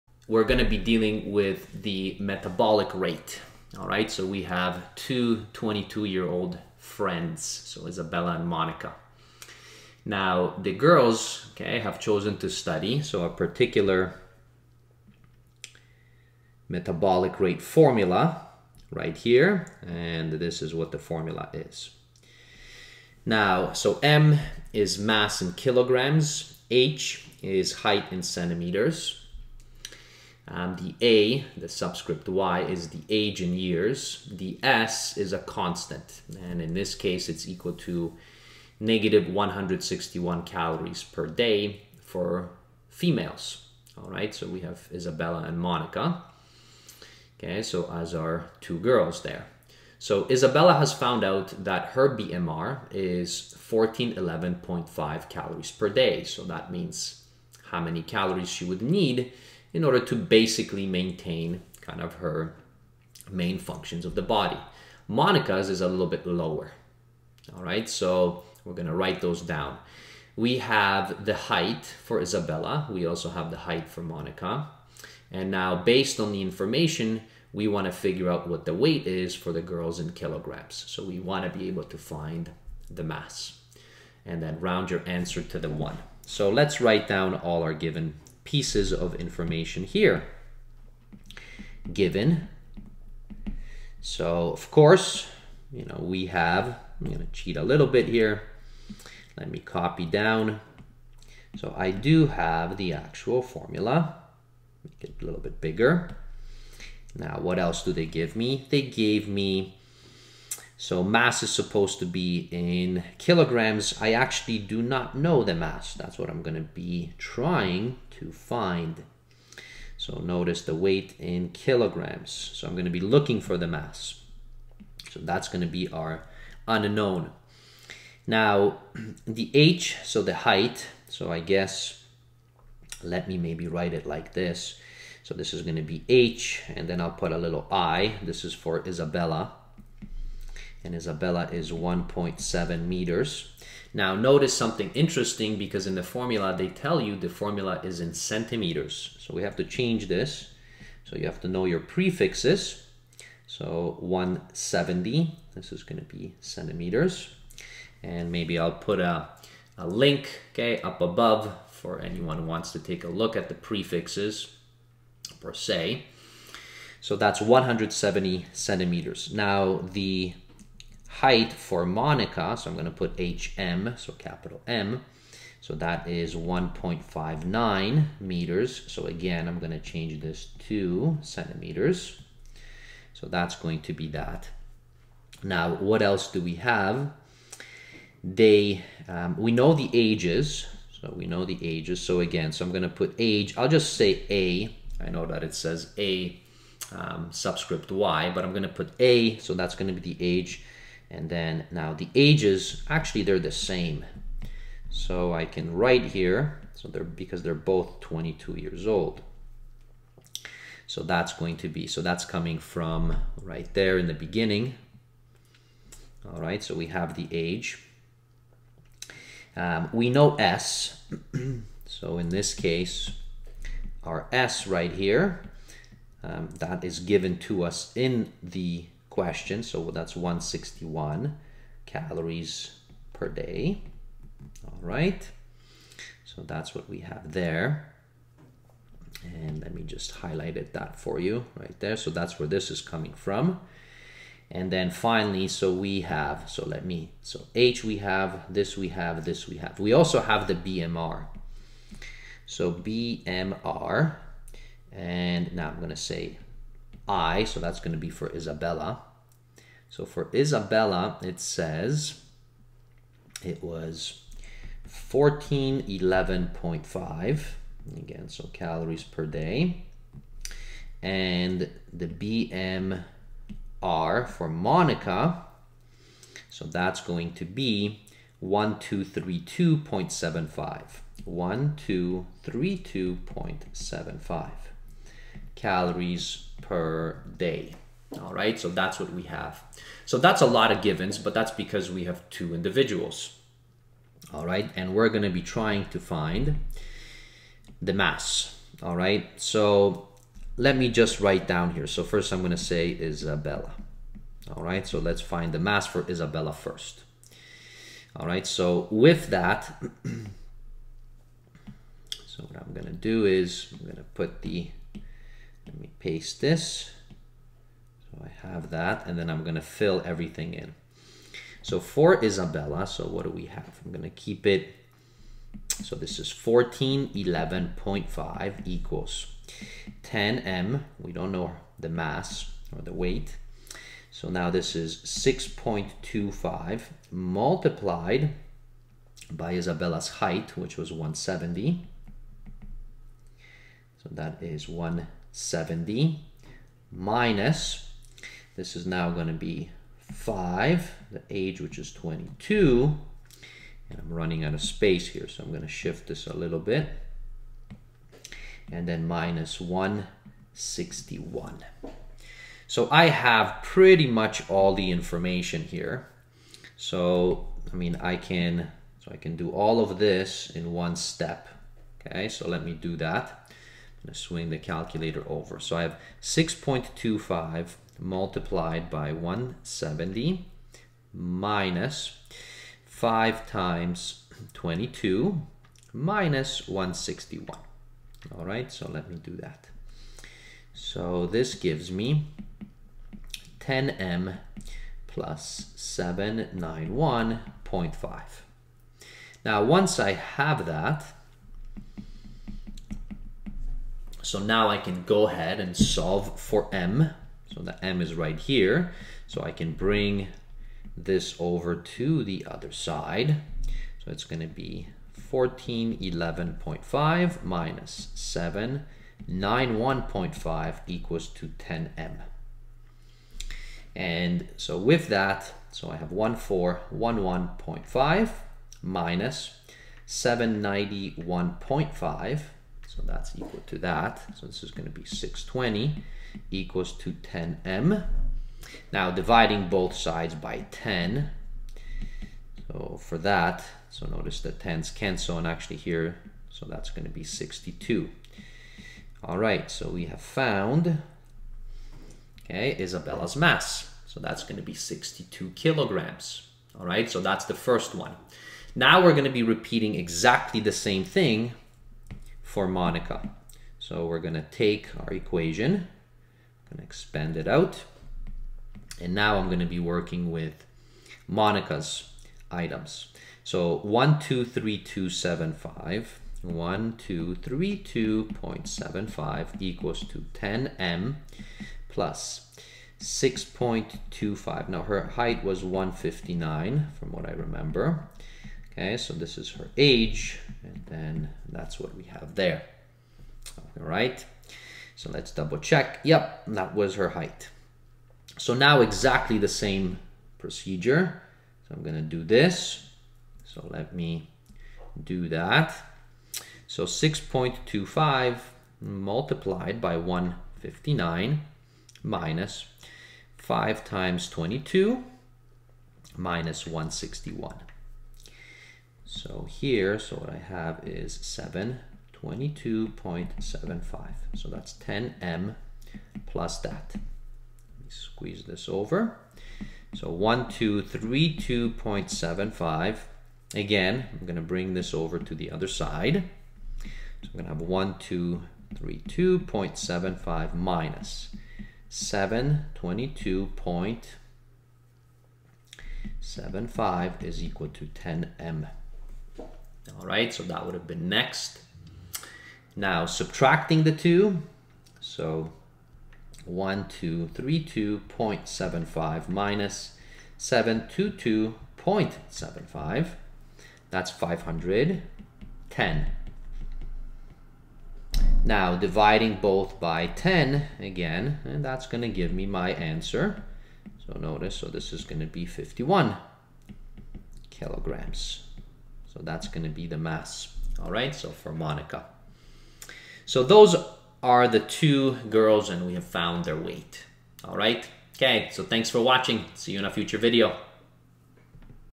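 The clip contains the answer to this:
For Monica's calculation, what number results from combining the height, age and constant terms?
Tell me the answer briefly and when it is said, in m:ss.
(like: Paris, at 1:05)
722.75, at 8:41.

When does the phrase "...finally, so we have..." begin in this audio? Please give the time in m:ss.
4:04.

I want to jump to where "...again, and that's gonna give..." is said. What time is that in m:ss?
9:30.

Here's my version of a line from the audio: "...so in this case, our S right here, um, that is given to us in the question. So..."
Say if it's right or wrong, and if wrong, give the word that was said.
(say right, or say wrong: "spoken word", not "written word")
right.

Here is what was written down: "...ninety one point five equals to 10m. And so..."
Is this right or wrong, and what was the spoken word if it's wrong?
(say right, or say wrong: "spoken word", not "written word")
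right.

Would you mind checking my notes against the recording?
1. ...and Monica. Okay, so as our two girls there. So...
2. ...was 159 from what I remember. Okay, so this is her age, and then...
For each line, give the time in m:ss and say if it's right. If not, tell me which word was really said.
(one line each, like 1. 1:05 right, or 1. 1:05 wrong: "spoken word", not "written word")
1. 0:45 right
2. 8:05 right.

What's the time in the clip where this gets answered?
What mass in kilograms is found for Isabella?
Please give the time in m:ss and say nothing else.
7:34.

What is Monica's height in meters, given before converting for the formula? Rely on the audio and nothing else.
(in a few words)
1.59 meters.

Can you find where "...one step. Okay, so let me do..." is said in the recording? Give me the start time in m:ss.
6:10.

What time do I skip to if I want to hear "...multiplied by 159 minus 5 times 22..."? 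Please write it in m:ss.
8:28.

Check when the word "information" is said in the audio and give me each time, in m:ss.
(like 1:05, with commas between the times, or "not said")
1:16, 1:29, 6:04.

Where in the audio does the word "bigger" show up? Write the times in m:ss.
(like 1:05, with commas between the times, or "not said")
1:45.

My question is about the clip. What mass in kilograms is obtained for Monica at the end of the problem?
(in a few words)
51 kilograms.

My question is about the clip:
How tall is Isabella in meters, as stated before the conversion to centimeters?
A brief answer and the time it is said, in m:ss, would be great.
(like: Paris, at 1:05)
1.7 meters, at 2:21.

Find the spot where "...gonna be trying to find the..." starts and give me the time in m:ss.
4:55.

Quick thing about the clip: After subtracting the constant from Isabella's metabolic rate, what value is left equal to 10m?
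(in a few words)
620.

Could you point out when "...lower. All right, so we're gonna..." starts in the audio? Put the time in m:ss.
1:06.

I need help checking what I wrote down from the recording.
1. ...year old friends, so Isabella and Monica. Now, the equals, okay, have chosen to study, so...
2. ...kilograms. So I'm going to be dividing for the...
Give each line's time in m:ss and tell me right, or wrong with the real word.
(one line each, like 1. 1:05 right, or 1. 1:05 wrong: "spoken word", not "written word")
1. 0:06 wrong: "girls", not "equals"
2. 2:01 wrong: "looking", not "dividing".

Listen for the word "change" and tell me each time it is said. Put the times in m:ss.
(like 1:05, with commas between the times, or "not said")
2:29, 2:59.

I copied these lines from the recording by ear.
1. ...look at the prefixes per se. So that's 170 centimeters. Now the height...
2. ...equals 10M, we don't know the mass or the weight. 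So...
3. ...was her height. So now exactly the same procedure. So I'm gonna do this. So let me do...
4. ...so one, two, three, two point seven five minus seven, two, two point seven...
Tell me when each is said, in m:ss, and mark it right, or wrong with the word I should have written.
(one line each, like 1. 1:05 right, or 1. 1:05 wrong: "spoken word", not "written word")
1. 2:43 right
2. 5:28 right
3. 8:16 right
4. 9:14 right.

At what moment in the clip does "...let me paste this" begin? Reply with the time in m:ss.
5:15.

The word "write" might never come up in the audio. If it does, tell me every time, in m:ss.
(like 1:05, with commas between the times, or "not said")
1:08, 1:26, 2:13, 3:25, 5:01.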